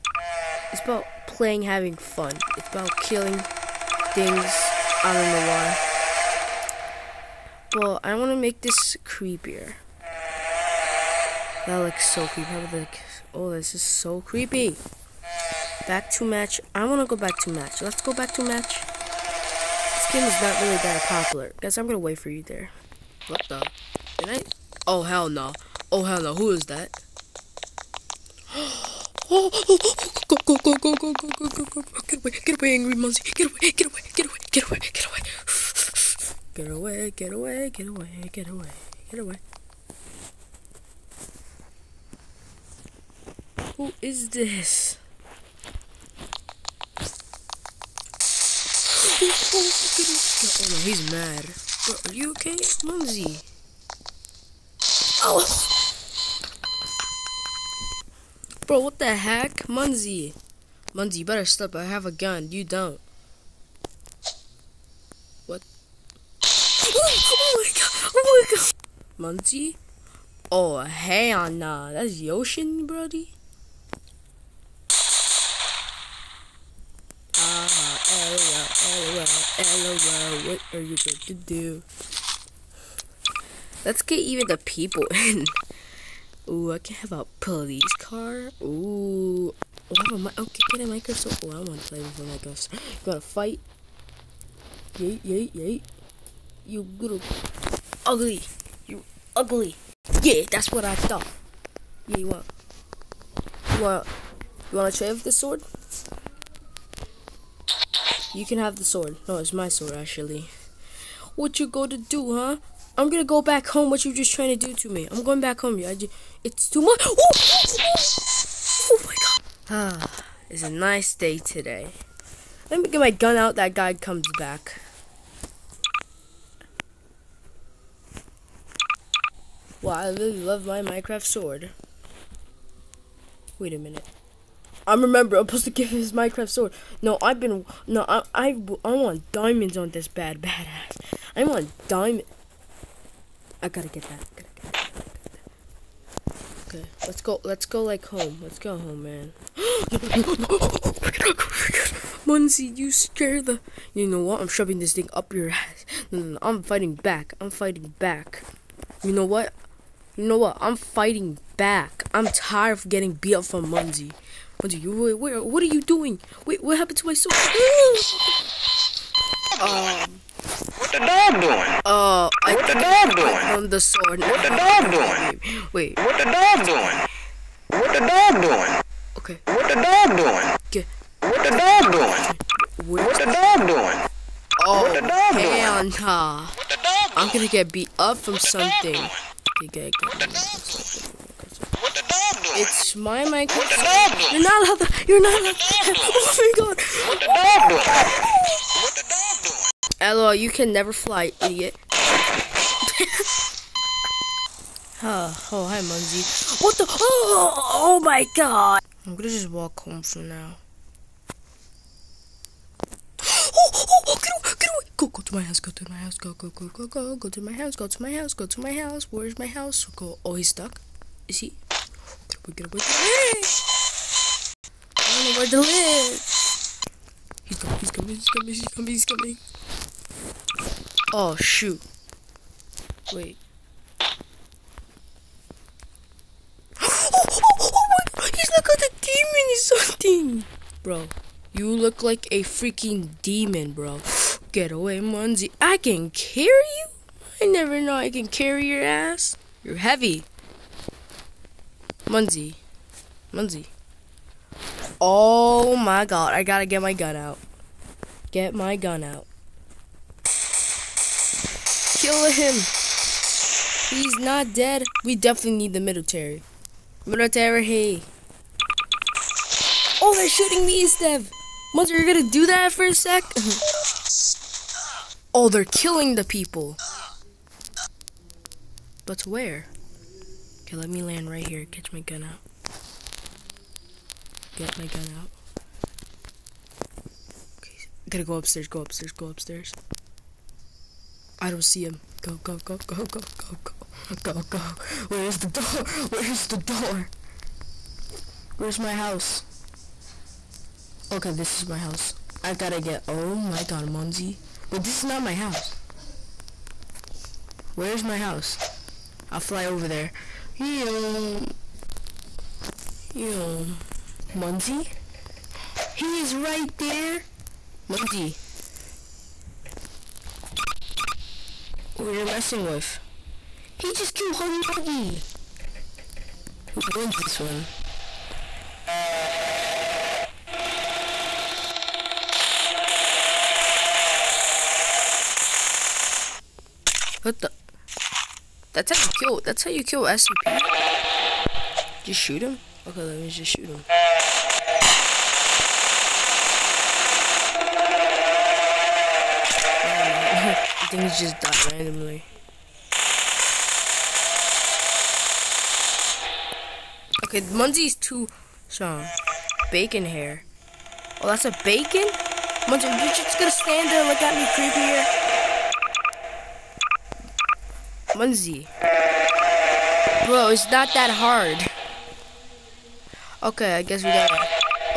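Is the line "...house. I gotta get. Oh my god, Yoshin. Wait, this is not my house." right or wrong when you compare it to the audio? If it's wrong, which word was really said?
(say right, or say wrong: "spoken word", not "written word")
wrong: "Munzie", not "Yoshin".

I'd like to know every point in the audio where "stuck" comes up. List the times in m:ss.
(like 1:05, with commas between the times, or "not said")
3:40.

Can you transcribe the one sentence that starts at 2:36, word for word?
No, no, no, I'm fighting back.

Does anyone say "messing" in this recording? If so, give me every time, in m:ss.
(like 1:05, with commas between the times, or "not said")
5:22.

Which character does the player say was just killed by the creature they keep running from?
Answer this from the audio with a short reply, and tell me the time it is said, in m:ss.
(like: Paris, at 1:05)
Huggy Wuggy, at 5:24.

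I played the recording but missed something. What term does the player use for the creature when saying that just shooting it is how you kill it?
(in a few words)
SCP.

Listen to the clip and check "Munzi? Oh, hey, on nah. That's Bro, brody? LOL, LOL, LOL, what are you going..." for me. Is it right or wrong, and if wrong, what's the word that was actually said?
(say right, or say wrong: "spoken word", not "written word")
wrong: "Yoshin", not "Bro".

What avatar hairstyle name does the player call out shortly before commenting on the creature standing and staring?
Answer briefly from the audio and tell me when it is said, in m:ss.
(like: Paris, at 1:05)
Bacon hair, at 5:59.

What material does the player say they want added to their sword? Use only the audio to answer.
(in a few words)
diamonds.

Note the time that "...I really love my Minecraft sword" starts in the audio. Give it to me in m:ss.
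2:09.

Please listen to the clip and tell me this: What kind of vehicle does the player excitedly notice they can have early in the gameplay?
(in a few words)
police car.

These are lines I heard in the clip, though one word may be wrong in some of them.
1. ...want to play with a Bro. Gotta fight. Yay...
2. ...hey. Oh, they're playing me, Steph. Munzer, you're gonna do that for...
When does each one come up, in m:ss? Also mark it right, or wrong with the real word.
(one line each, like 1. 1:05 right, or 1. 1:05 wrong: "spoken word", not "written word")
1. 1:31 wrong: "Microsoft", not "Bro"
2. 4:27 wrong: "shooting", not "playing".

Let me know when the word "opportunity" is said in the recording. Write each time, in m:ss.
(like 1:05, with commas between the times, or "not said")
not said.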